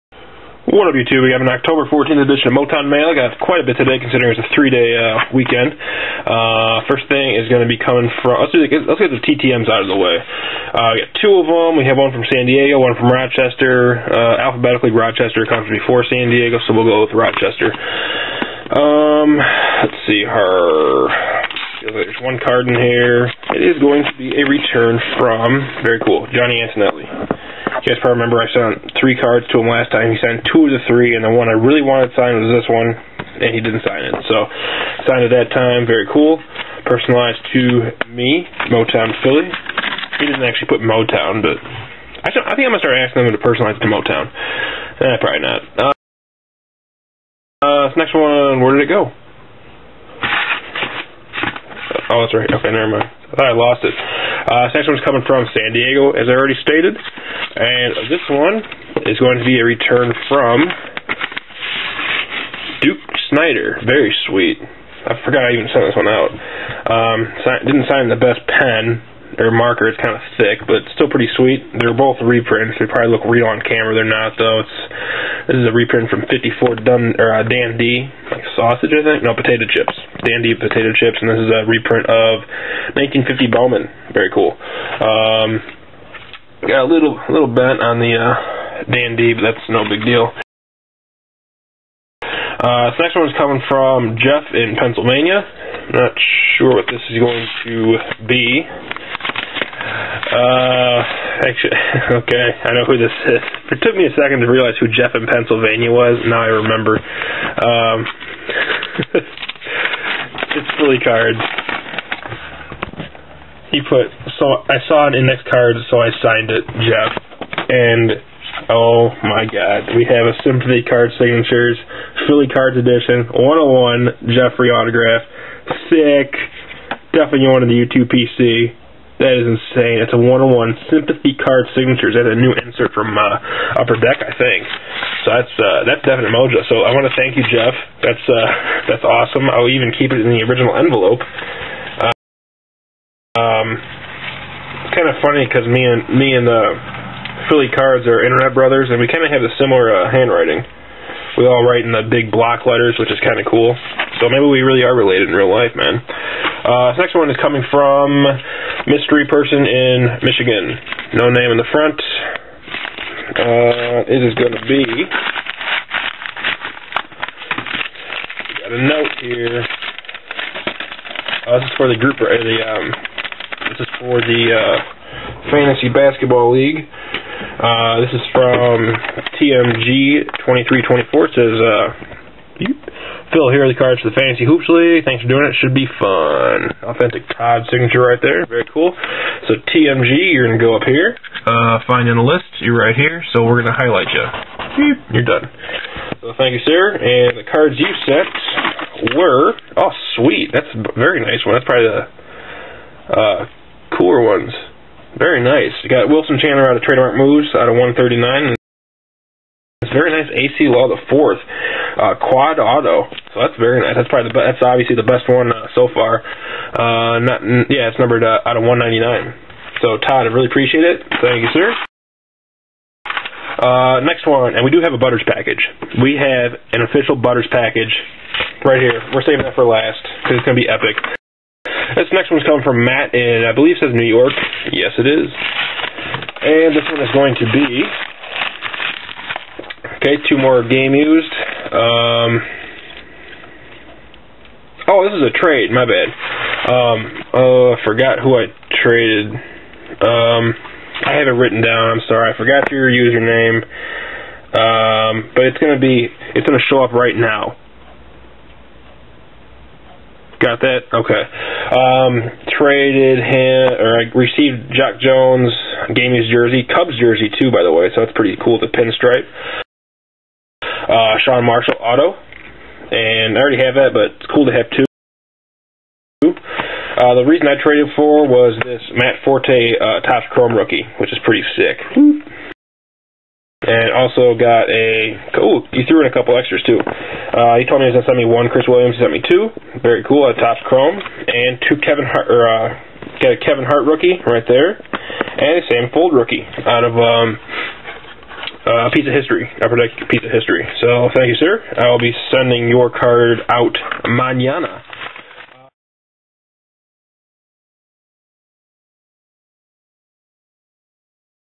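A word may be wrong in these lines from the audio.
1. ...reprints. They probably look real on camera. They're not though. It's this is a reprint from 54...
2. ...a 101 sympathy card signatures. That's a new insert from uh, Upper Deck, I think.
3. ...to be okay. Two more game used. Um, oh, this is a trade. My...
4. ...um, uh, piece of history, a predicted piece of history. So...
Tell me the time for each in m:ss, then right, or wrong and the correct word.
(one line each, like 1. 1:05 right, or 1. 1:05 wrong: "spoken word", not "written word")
1. 1:12 right
2. 2:10 right
3. 3:57 right
4. 4:56 right.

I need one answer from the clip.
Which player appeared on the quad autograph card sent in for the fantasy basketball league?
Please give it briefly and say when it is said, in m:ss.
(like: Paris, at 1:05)
Acie Law, at 3:30.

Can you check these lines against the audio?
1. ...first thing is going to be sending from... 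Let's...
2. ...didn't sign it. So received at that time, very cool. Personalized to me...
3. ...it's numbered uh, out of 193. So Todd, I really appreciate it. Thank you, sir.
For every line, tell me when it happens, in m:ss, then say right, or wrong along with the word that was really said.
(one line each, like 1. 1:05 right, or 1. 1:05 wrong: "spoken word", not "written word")
1. 0:06 wrong: "coming", not "sending"
2. 0:33 wrong: "signed", not "received"
3. 3:37 wrong: "199", not "193".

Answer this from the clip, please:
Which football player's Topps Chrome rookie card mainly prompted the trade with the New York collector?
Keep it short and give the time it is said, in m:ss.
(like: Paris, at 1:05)
Matt Forte, at 4:38.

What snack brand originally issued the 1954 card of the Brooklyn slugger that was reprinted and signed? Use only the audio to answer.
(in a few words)
Dandy potato chips.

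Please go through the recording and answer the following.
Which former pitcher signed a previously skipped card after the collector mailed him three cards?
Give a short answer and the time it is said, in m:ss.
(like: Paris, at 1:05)
Johnny Antonelli, at 0:26.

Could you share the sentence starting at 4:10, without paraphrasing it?
Um, I have it written down.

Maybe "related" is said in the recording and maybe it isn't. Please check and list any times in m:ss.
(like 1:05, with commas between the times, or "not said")
2:34.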